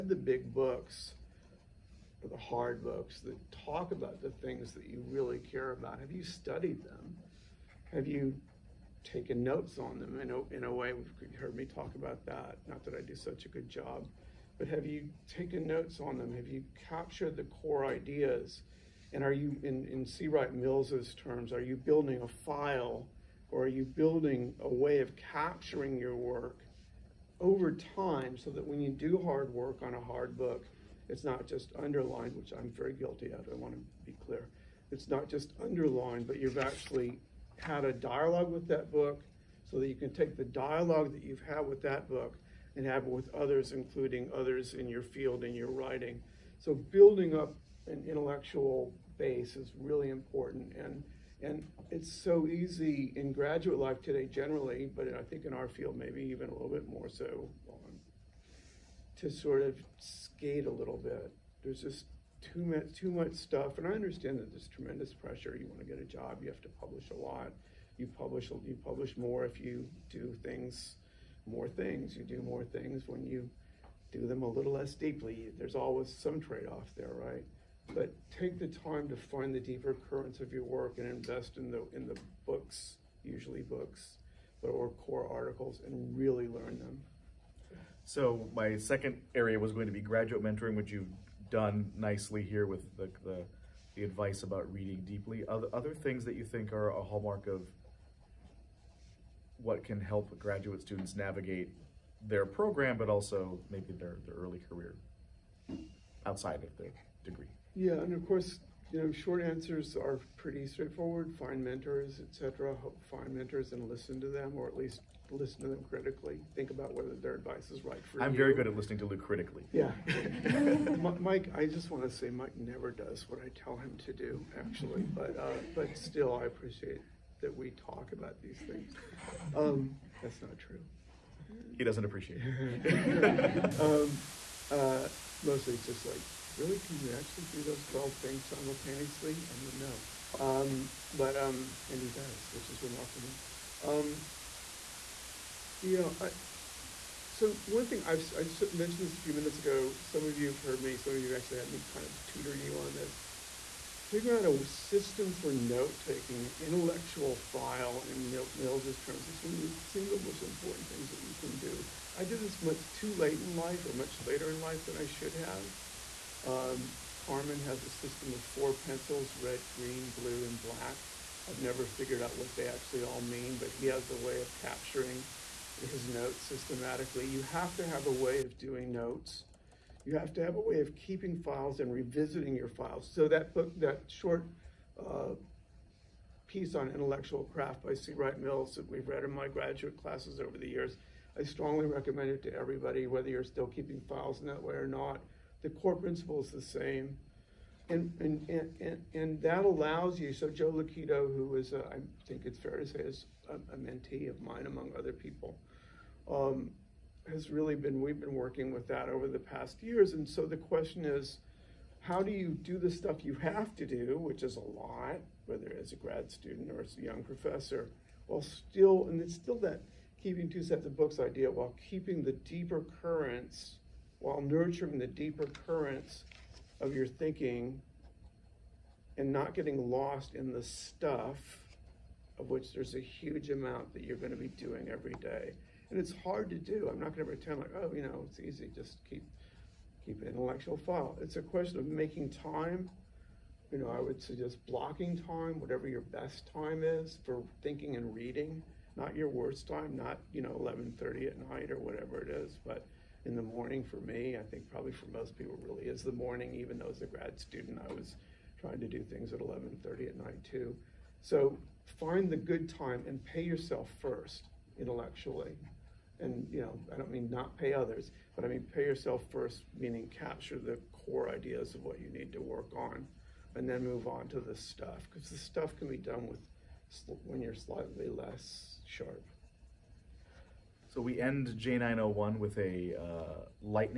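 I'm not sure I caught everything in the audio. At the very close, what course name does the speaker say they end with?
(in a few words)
J901.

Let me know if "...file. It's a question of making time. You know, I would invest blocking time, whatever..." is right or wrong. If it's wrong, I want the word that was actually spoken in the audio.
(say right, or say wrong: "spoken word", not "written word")
wrong: "suggest", not "invest".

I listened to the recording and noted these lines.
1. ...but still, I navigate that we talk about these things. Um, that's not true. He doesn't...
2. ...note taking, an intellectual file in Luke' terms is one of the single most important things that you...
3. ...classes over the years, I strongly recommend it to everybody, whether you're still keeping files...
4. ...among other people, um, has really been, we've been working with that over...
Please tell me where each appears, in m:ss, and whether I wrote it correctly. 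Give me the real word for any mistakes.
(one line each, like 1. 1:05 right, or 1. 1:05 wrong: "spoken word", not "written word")
1. 2:05 wrong: "appreciate", not "navigate"
2. 2:35 wrong: "Mills", not "Luke"
3. 3:10 right
4. 3:24 right.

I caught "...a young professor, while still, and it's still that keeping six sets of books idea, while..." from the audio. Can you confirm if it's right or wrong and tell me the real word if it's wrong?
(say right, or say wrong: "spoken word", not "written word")
wrong: "two", not "six".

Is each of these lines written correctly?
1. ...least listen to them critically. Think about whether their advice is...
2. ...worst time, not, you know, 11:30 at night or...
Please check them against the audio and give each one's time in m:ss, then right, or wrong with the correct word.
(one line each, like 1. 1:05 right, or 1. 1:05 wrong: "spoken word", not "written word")
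1. 1:54 right
2. 4:09 right.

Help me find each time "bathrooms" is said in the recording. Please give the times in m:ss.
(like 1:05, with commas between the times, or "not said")
not said.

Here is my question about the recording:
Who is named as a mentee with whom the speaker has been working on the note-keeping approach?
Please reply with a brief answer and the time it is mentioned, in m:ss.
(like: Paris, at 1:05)
Joe Lukito, at 3:20.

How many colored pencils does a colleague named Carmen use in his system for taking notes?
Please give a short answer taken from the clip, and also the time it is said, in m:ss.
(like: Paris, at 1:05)
4, at 2:48.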